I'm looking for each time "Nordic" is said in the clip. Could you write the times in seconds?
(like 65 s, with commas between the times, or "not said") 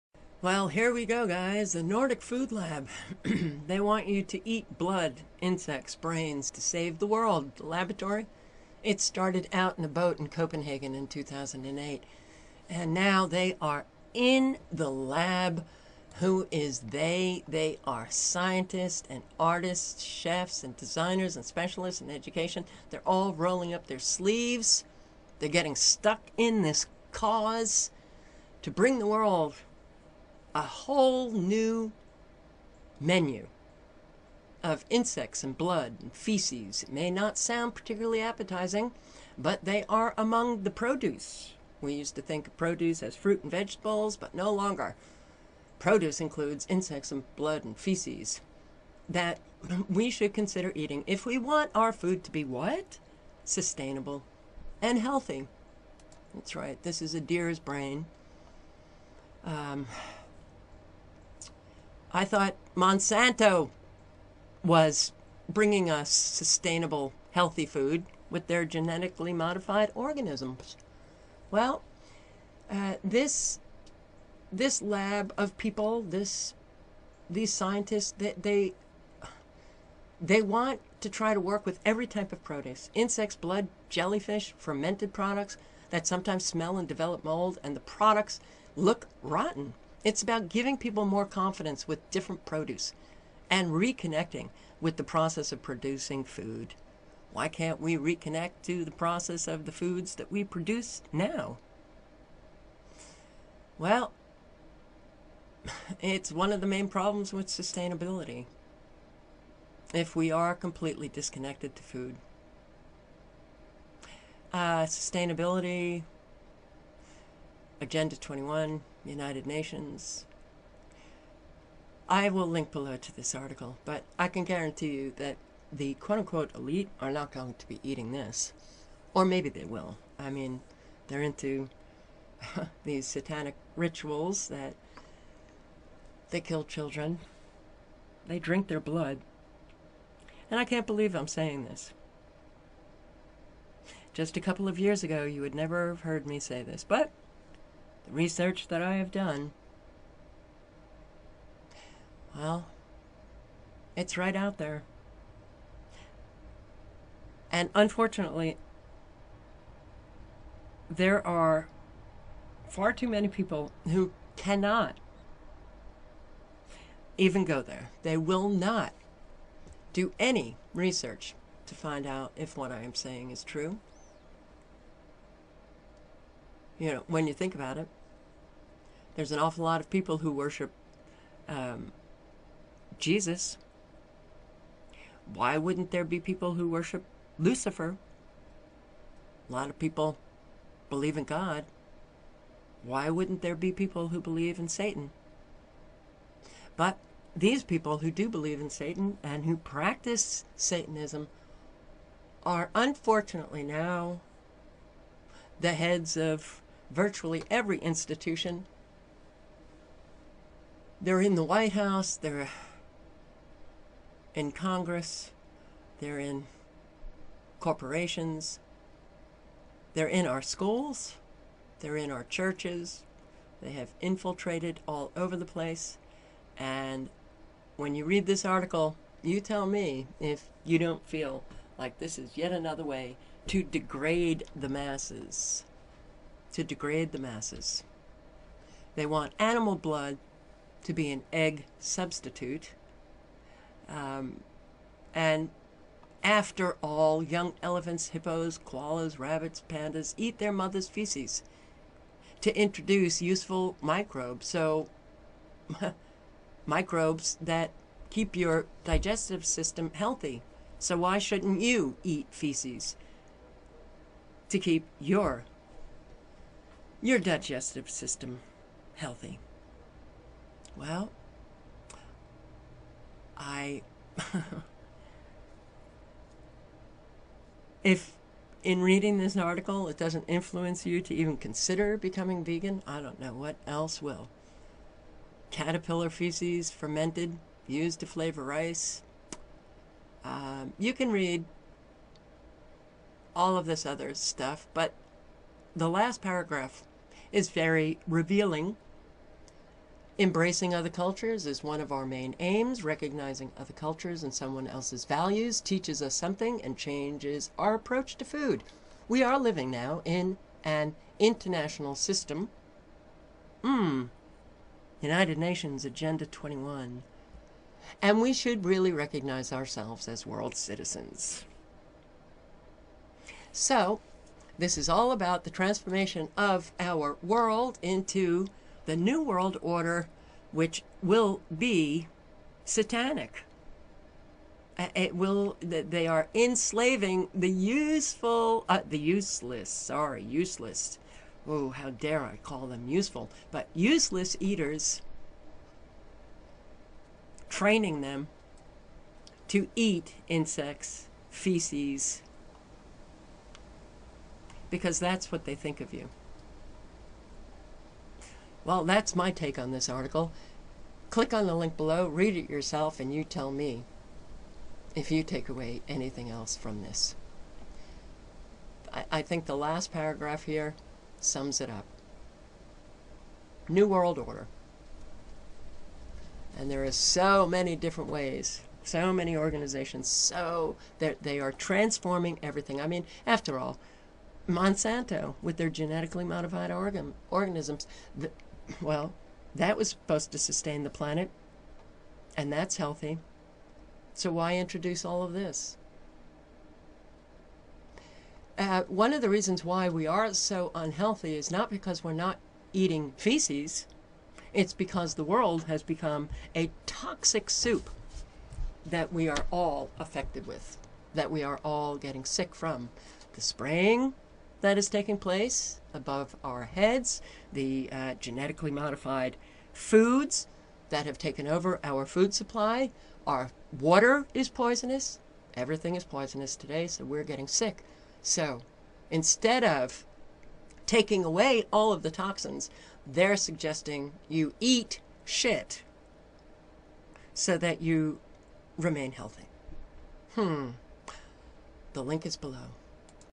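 1 s.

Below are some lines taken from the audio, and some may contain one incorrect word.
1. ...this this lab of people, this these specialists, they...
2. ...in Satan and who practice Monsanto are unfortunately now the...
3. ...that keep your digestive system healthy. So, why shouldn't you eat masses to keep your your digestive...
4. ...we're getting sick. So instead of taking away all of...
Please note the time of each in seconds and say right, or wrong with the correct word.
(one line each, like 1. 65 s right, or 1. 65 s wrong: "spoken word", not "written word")
1. 73 s wrong: "scientists", not "specialists"
2. 198 s wrong: "Satanism", not "Monsanto"
3. 257 s wrong: "feces", not "masses"
4. 427 s right.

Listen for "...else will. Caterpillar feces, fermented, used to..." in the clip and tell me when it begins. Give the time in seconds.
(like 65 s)
283 s.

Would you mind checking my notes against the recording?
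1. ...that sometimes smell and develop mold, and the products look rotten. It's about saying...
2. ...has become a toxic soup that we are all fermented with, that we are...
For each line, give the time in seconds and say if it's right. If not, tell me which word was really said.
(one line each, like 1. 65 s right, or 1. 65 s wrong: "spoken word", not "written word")
1. 85 s wrong: "giving", not "saying"
2. 405 s wrong: "affected", not "fermented".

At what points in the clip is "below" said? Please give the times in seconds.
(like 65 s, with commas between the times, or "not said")
122 s, 361 s, 442 s.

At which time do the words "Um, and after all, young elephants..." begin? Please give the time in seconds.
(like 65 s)
243 s.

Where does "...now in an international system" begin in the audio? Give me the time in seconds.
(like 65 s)
309 s.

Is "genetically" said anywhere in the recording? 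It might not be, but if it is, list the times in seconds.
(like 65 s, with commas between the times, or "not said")
68 s, 385 s, 418 s.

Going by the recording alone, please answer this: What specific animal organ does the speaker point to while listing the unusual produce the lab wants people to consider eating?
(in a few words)
a deer's brain.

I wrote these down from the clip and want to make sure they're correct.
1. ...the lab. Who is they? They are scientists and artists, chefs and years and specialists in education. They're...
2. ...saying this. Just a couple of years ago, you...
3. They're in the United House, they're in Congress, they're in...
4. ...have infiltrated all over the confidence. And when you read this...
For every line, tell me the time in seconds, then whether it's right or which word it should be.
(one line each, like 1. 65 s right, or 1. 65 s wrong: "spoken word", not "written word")
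1. 14 s wrong: "designers", not "years"
2. 141 s right
3. 211 s wrong: "White", not "United"
4. 223 s wrong: "place", not "confidence".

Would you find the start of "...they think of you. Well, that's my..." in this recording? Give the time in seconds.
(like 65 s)
355 s.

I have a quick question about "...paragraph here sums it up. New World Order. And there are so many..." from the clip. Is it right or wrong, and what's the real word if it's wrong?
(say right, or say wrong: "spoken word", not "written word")
right.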